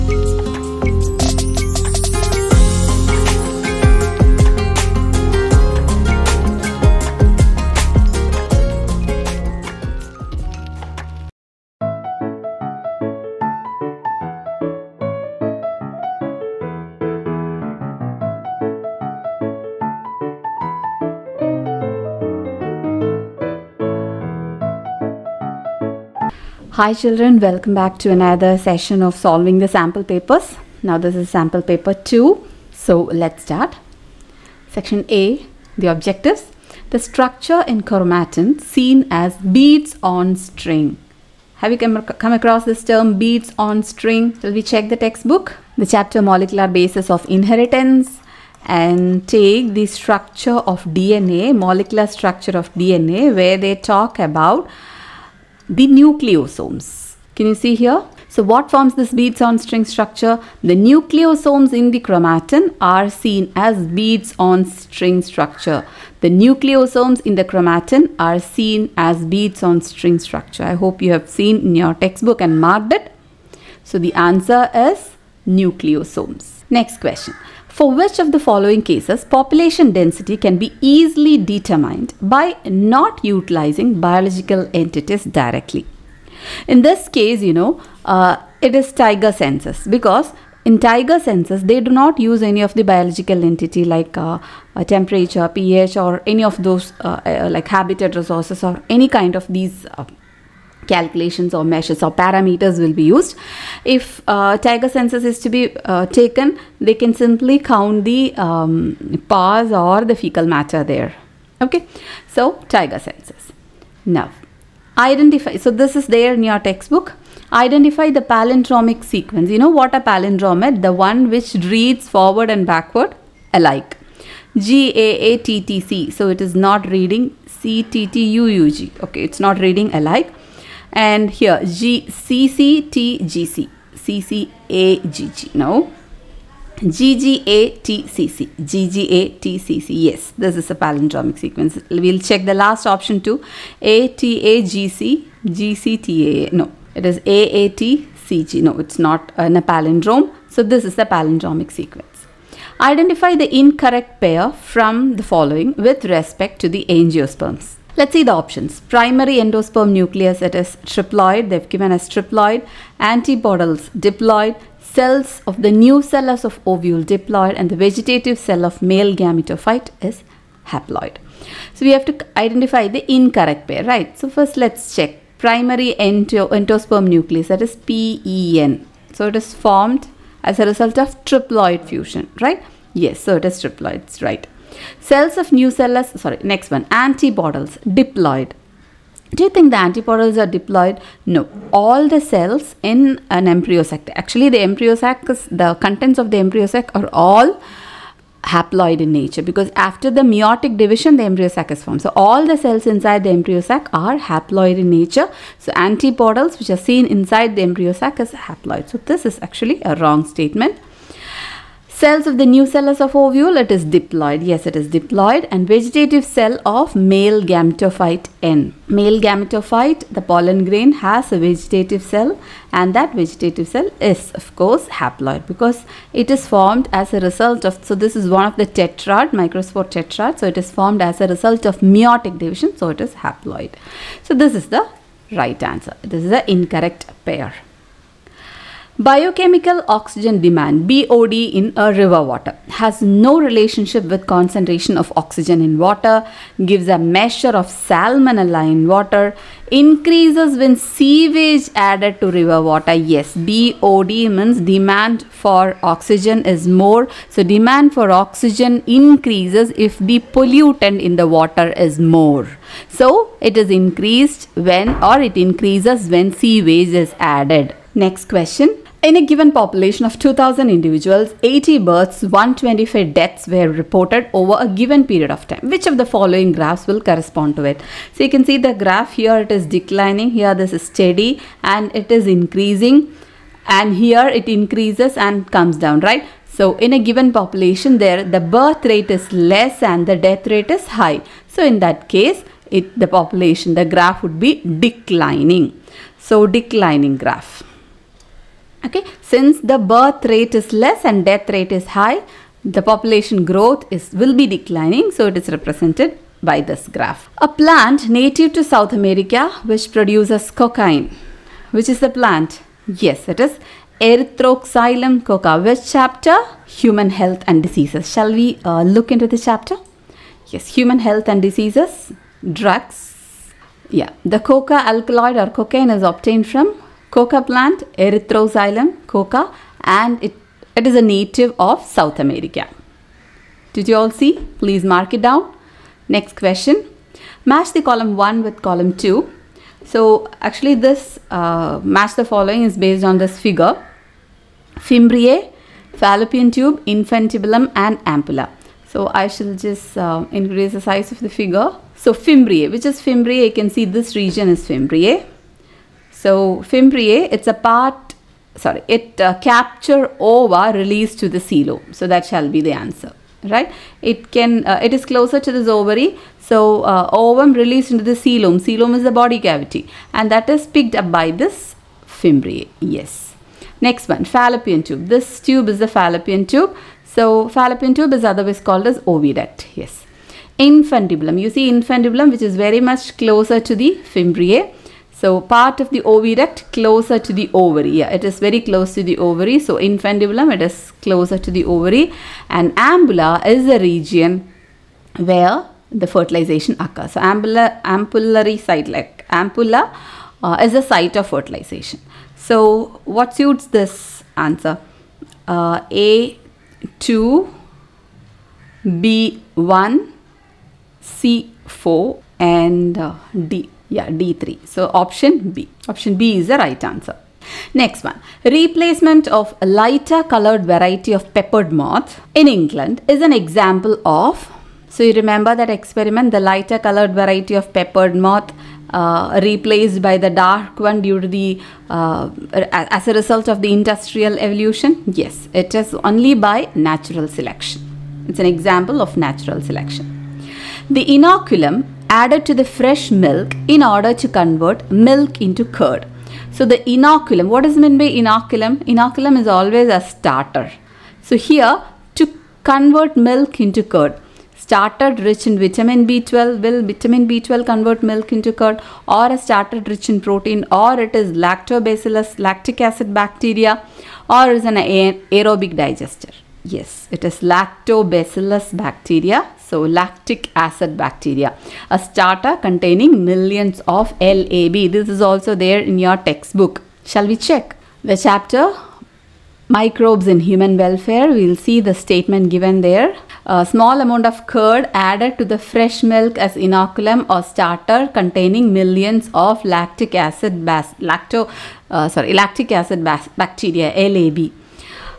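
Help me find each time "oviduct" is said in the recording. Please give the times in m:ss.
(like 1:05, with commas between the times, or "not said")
6:18.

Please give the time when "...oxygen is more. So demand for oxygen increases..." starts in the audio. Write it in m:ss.
4:15.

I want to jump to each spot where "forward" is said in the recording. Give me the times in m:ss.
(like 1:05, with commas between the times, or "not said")
2:02.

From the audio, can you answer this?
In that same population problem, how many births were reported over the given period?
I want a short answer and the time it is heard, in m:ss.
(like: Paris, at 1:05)
80, at 4:31.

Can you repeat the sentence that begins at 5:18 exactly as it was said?
Shall we uh, look into this chapter?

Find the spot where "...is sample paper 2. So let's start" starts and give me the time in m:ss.
0:31.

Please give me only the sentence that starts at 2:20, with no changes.
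Yes, this is a palindromic sequence.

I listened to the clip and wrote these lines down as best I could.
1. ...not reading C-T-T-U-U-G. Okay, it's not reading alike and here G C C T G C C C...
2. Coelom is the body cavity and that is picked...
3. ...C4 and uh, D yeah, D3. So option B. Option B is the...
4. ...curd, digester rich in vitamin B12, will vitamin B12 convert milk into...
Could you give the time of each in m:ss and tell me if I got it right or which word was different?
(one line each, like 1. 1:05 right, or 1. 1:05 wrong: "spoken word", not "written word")
1. 2:06 right
2. 6:08 right
3. 6:51 right
4. 7:33 wrong: "starter", not "digester".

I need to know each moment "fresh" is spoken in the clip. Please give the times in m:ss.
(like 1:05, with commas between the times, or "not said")
7:22, 8:05.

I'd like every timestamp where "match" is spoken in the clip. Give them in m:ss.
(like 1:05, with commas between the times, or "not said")
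5:37, 5:41.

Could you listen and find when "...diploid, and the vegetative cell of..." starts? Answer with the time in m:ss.
2:47.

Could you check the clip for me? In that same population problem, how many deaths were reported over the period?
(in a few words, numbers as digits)
125.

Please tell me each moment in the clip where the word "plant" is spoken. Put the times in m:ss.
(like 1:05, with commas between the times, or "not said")
5:07, 5:12, 5:27.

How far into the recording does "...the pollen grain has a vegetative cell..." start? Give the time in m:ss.
3:40.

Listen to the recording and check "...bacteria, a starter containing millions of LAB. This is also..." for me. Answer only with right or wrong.
right.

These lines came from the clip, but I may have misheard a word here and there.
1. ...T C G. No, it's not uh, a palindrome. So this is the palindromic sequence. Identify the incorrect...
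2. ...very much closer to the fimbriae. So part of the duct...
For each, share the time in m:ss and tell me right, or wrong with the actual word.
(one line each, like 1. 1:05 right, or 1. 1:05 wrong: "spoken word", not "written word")
1. 2:27 right
2. 6:22 right.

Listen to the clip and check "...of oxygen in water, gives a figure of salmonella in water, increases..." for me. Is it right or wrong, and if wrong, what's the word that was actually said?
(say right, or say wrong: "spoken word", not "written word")
wrong: "measure", not "figure".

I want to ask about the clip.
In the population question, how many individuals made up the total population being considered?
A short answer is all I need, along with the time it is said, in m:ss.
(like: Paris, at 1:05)
2000, at 4:30.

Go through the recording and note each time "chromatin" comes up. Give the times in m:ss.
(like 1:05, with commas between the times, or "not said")
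0:37, 1:01, 1:07.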